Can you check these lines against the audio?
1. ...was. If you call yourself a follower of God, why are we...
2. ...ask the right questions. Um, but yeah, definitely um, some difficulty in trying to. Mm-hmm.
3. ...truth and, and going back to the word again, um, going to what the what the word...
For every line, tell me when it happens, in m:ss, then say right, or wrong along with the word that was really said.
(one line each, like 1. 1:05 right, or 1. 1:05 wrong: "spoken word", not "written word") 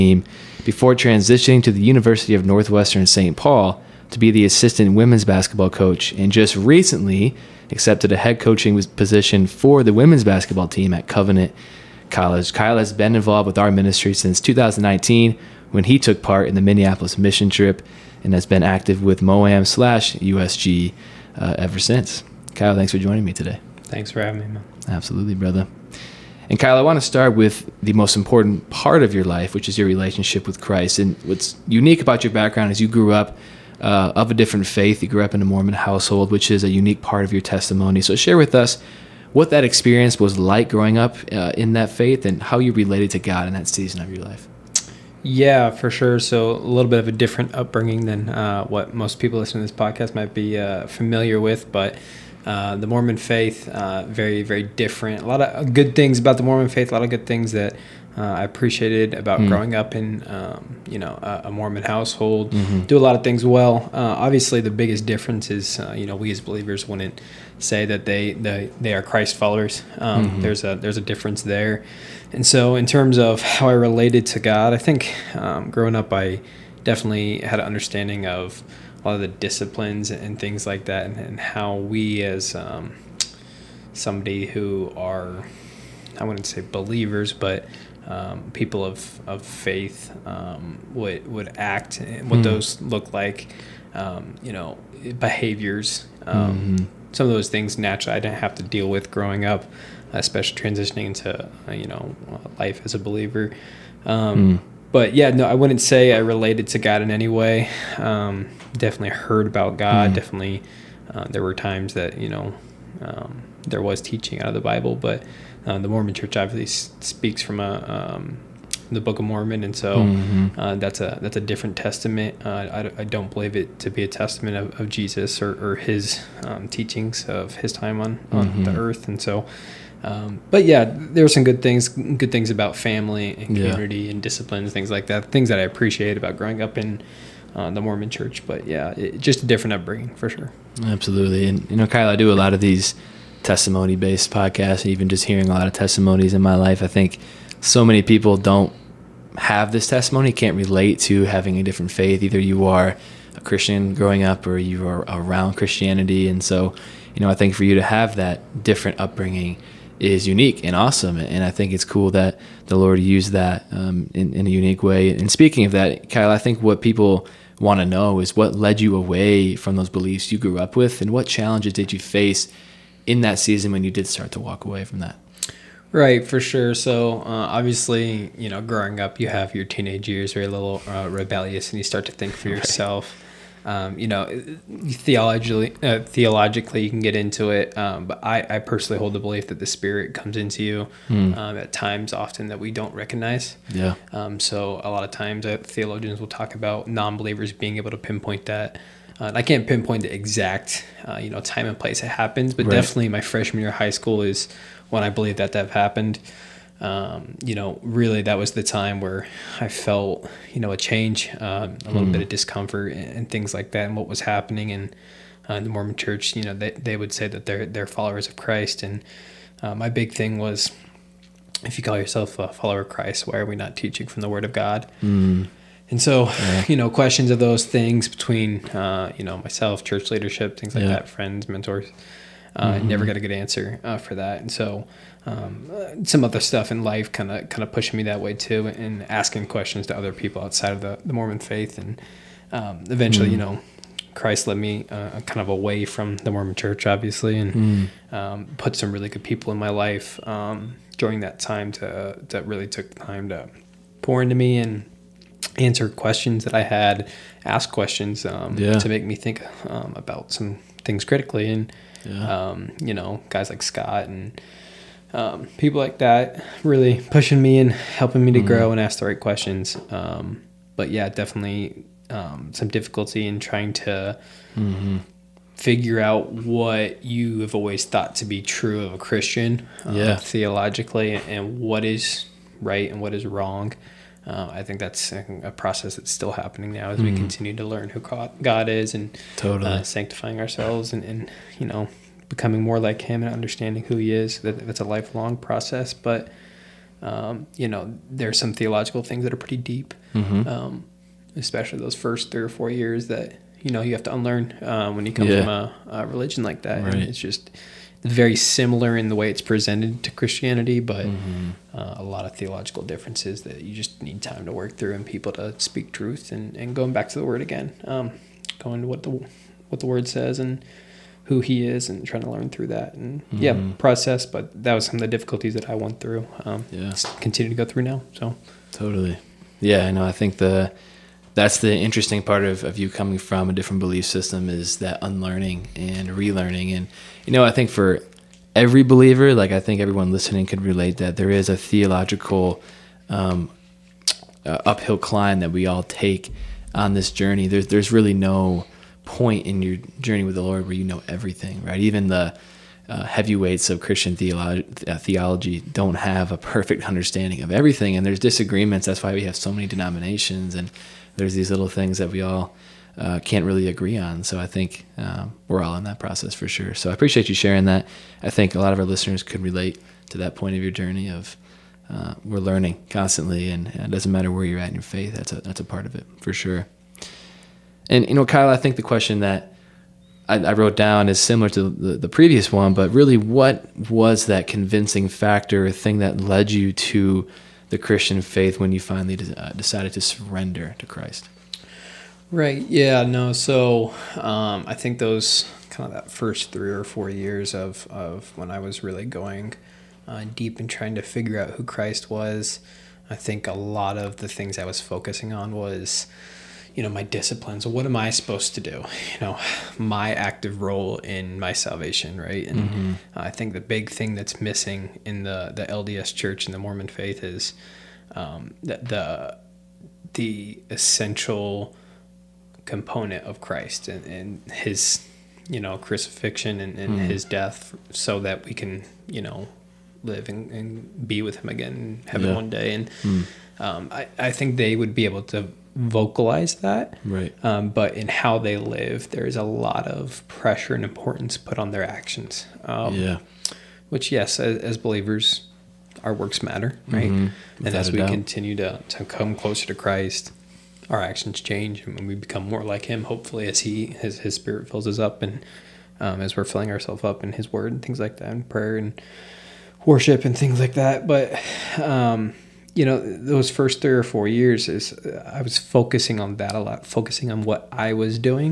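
1. 3:40 wrong: "Christ", not "God"
2. 4:28 right
3. 5:15 right.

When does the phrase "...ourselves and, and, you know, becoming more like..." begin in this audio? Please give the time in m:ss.
4:50.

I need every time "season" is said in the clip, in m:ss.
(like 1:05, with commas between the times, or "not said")
0:43, 2:53.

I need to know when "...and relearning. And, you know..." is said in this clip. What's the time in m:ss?
5:35.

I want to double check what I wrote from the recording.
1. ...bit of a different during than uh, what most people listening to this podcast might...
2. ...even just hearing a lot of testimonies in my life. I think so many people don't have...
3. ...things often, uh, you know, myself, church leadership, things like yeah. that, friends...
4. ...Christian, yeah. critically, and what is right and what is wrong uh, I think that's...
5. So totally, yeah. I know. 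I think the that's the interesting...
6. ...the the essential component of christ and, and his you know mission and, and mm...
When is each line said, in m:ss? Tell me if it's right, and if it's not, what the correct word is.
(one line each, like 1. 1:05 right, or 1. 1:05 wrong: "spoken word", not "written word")
1. 0:46 wrong: "upbringing", not "during"
2. 2:24 right
3. 3:47 wrong: "between", not "often"
4. 4:38 wrong: "theologically", not "critically"
5. 5:28 right
6. 6:58 wrong: "crucifixion", not "mission".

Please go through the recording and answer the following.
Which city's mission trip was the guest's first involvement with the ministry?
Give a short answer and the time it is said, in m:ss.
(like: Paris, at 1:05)
Minneapolis, at 0:16.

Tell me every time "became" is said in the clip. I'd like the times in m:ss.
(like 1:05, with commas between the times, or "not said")
not said.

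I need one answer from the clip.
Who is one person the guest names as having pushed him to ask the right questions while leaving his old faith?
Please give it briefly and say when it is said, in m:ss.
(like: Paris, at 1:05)
Scott, at 4:23.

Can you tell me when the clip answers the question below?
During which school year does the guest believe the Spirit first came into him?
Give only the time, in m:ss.
3:23.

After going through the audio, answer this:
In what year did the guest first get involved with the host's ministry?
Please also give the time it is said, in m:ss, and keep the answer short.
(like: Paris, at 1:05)
2019, at 0:14.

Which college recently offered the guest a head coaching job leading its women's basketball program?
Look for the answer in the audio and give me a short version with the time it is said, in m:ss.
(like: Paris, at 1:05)
Covenant College, at 0:11.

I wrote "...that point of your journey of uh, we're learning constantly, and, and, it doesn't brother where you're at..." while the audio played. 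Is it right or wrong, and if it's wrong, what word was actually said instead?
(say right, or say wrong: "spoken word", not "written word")
wrong: "matter", not "brother".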